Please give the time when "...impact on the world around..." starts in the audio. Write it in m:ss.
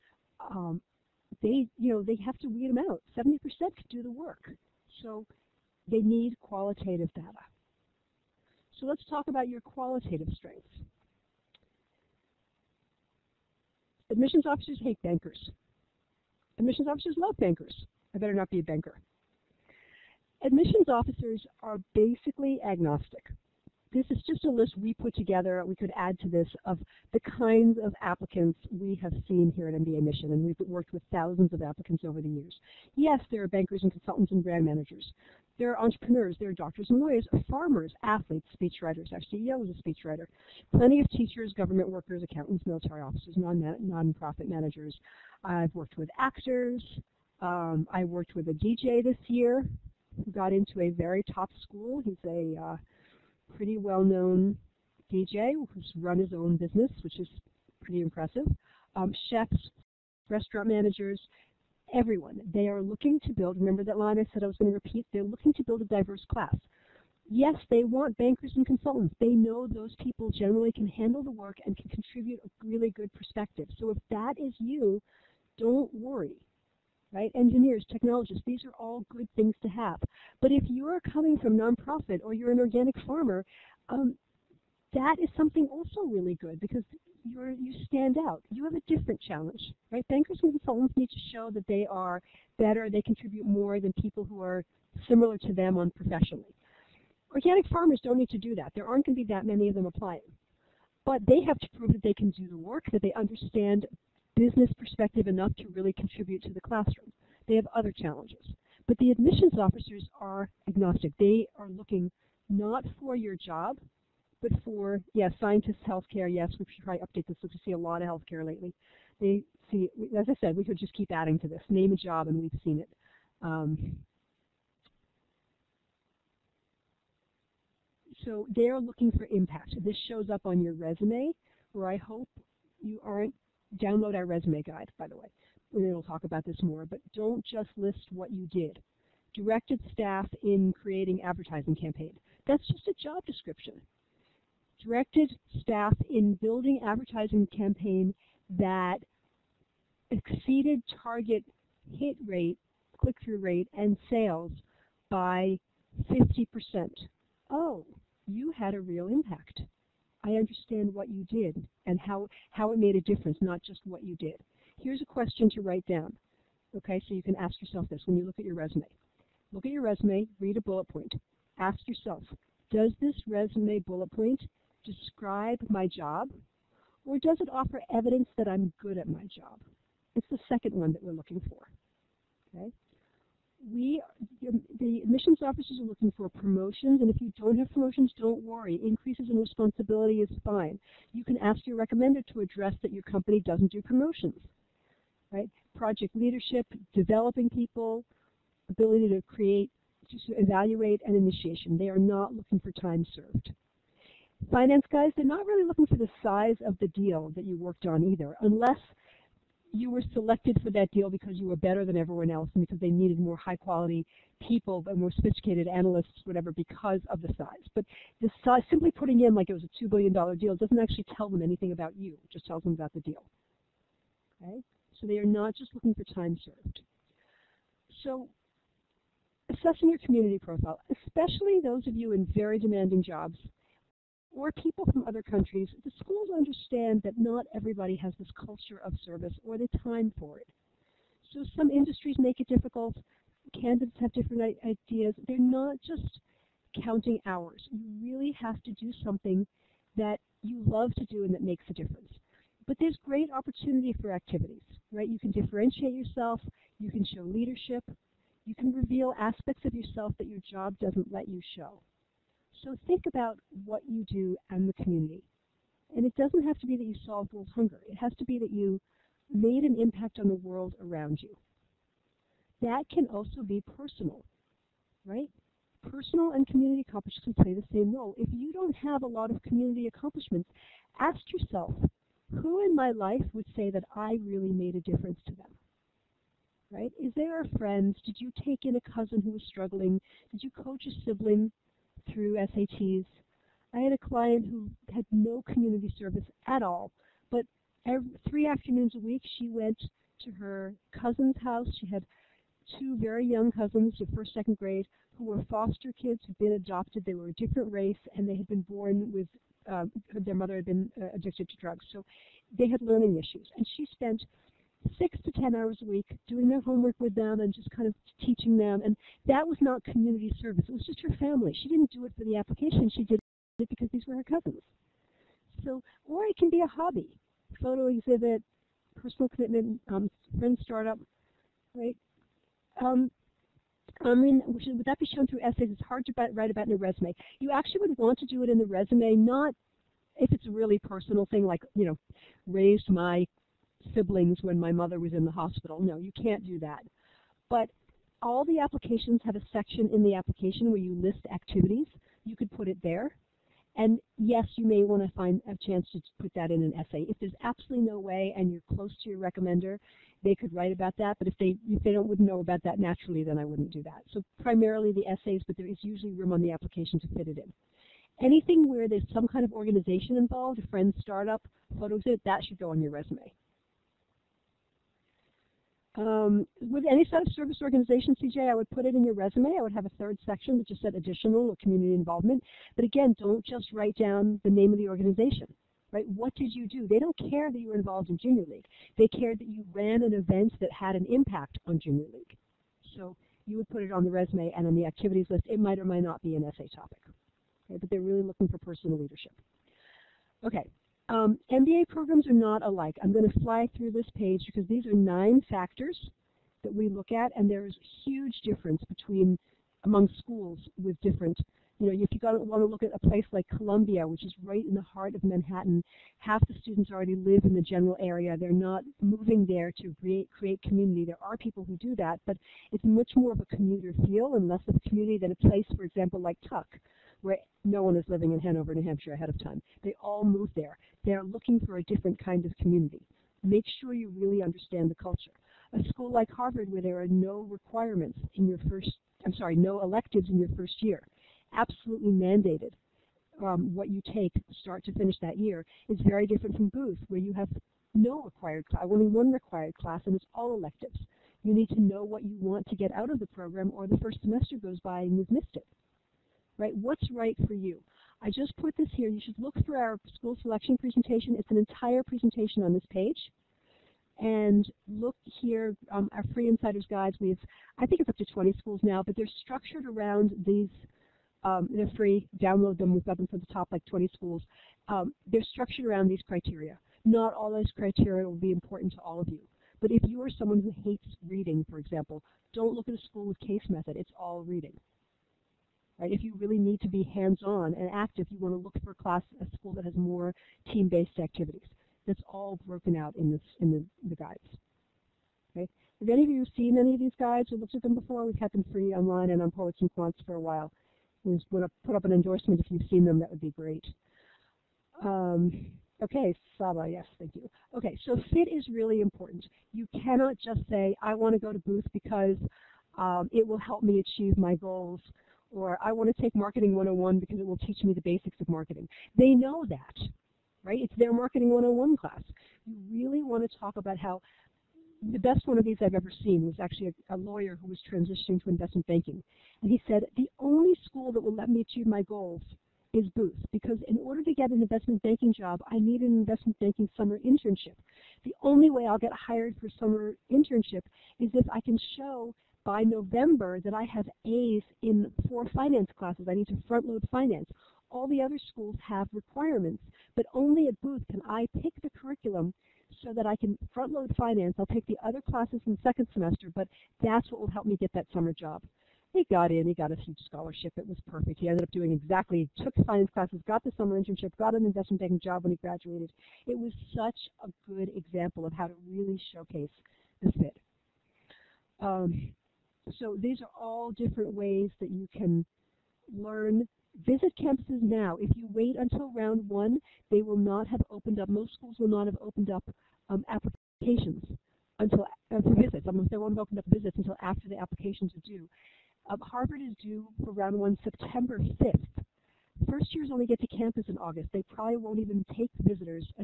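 4:29.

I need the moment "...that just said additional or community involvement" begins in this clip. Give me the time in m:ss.
6:20.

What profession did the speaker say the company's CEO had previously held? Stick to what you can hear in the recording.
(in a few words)
Speechwriter.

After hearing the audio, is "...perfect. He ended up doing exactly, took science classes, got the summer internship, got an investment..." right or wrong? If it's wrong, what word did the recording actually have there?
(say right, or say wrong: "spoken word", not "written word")
right.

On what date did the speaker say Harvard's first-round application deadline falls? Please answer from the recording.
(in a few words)
September 5.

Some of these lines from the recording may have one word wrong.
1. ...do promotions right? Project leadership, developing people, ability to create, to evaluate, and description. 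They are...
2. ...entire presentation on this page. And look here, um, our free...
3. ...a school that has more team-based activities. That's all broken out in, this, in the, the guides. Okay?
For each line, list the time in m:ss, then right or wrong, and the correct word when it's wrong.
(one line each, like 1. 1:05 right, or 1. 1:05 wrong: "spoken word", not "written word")
1. 3:13 wrong: "initiation", not "description"
2. 7:41 right
3. 8:09 right.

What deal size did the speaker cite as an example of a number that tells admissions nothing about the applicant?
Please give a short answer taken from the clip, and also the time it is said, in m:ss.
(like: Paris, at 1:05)
$2 billion, at 3:39.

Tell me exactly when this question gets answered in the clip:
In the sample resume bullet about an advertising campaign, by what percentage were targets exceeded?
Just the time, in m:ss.
2:36.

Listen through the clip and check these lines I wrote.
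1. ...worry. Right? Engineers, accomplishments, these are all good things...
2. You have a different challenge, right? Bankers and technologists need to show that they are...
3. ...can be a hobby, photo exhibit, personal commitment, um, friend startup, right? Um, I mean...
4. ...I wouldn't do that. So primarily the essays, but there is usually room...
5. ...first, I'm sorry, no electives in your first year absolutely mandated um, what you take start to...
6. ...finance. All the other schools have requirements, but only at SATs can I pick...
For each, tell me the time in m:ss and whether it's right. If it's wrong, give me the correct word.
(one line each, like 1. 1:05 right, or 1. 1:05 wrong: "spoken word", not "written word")
1. 1:15 wrong: "technologists", not "accomplishments"
2. 1:28 wrong: "consultants", not "technologists"
3. 5:26 right
4. 6:03 right
5. 7:18 right
6. 9:07 wrong: "Booth", not "SATs".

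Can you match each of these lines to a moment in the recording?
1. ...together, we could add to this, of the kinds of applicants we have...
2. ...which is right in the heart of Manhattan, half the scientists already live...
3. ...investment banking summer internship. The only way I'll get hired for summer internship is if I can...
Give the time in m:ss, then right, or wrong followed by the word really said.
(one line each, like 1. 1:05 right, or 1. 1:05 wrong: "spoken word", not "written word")
1. 0:25 right
2. 6:54 wrong: "students", not "scientists"
3. 8:56 right.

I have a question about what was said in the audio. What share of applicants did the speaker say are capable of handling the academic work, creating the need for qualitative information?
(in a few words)
70%.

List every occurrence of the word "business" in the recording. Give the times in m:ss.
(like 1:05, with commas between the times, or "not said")
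0:56, 1:44.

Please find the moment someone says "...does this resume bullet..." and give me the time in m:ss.
2:52.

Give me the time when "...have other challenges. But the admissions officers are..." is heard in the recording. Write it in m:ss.
1:47.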